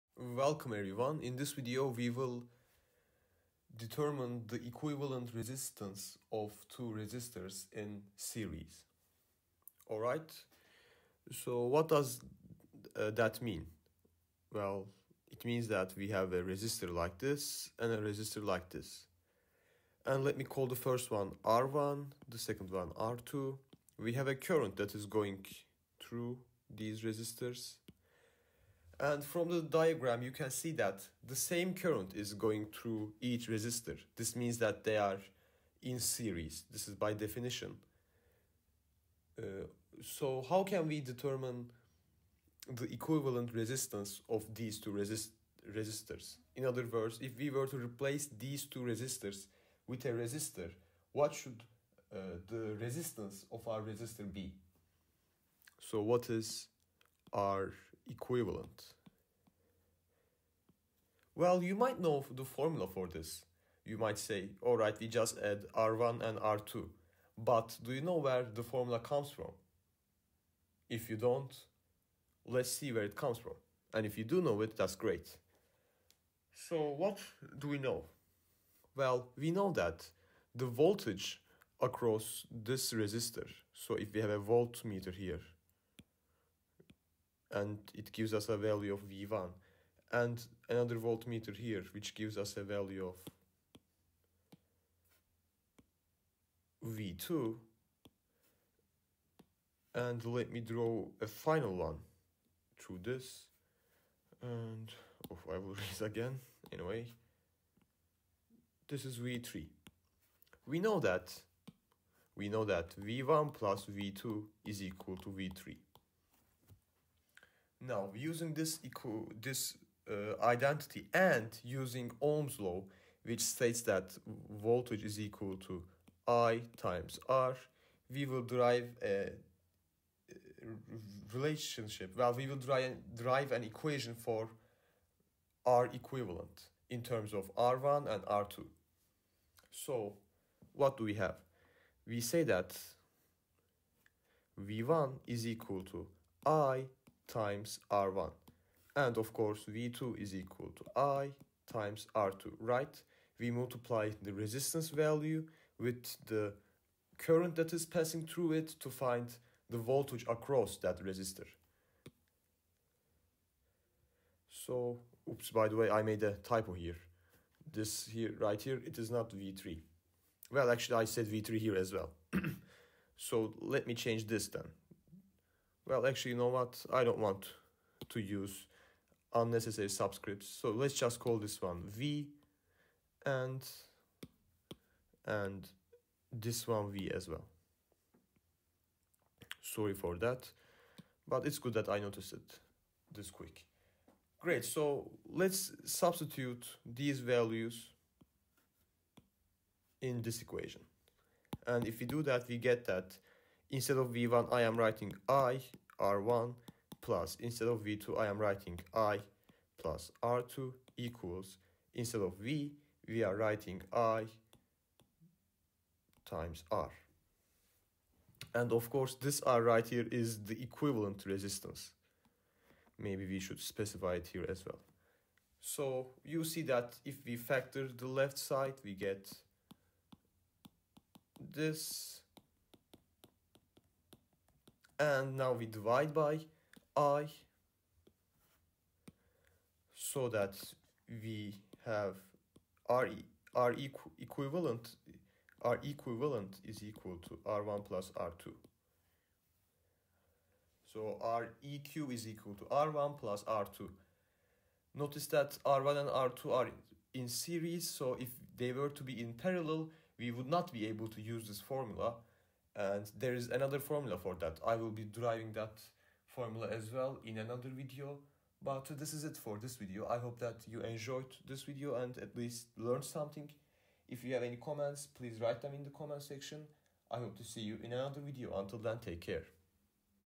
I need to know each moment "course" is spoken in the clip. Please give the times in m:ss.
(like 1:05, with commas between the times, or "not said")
2:29, 3:38.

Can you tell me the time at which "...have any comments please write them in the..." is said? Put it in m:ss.
4:34.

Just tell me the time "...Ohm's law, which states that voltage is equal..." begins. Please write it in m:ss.
2:02.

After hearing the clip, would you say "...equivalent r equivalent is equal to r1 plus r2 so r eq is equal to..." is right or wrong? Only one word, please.
right.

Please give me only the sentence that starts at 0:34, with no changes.
This means that they are in series.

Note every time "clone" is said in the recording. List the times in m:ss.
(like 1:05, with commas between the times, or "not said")
not said.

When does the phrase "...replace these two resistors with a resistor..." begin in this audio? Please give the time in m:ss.
0:47.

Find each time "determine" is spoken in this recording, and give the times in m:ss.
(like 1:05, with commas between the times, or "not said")
0:03, 0:41.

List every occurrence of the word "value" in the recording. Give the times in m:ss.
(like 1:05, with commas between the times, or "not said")
1:28, 1:32, 2:34, 3:17.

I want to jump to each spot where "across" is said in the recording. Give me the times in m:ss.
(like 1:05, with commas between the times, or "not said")
1:21, 2:40.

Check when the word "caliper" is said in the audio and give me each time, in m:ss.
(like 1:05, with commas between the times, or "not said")
not said.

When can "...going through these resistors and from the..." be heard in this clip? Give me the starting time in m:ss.
0:25.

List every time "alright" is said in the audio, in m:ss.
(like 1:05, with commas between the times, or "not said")
0:09, 1:04.